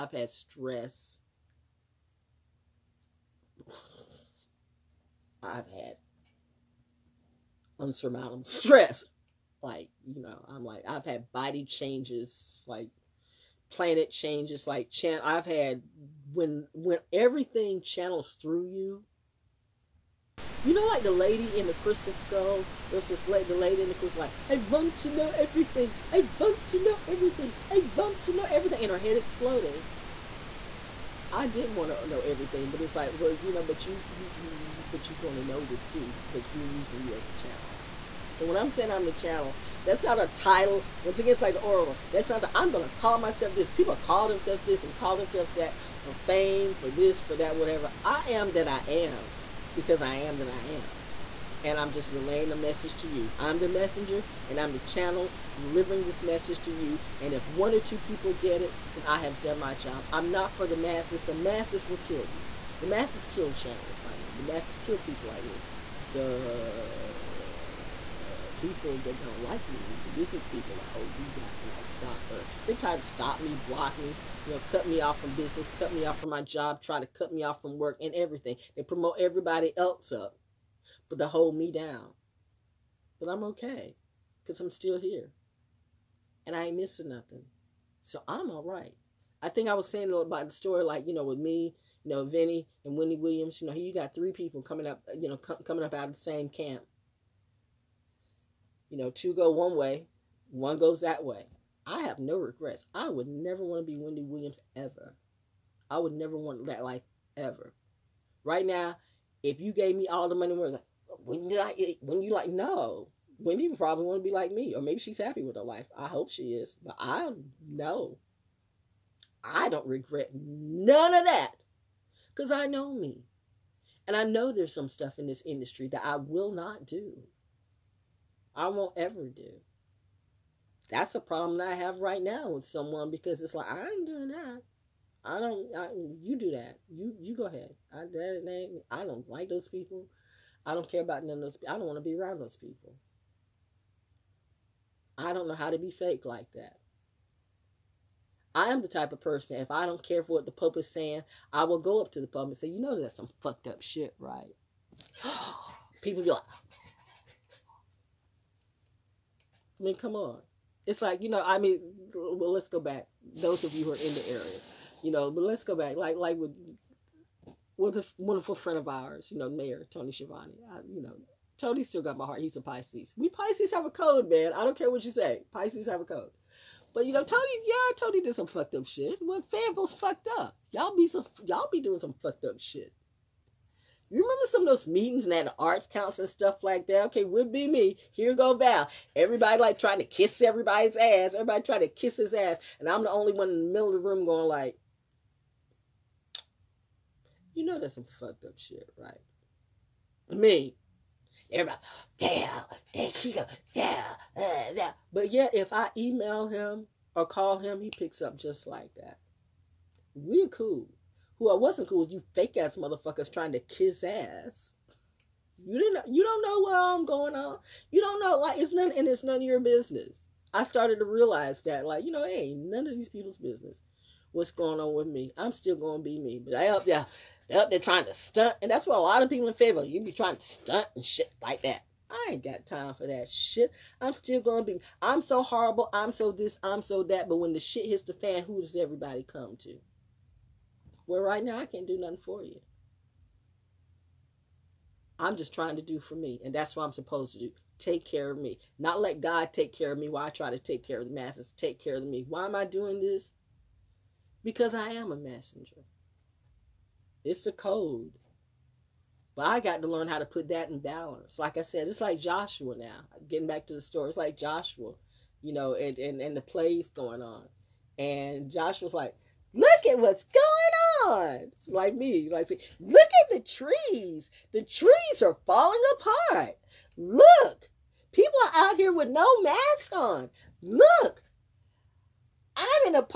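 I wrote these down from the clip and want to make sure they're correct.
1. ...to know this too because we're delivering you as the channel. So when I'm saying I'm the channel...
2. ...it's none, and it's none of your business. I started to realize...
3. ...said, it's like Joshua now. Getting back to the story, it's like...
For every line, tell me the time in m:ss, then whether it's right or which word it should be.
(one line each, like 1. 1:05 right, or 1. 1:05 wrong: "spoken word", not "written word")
1. 0:35 wrong: "using", not "delivering"
2. 3:38 right
3. 4:21 right.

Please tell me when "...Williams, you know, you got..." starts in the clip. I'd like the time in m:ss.
1:33.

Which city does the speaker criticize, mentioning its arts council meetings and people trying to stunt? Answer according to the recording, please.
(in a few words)
Fayetteville.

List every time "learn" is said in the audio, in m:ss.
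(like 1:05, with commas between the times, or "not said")
4:19.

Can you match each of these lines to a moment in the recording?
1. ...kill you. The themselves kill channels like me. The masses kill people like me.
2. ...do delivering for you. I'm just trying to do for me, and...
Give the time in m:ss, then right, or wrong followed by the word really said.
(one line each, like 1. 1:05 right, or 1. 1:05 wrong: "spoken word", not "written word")
1. 1:01 wrong: "masses", not "themselves"
2. 4:01 wrong: "nothing", not "delivering".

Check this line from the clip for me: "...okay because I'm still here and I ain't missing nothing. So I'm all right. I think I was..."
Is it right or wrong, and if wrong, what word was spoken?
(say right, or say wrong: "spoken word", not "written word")
right.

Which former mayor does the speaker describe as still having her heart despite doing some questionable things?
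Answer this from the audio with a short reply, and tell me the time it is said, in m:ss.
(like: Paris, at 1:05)
Tony Chavonne, at 2:49.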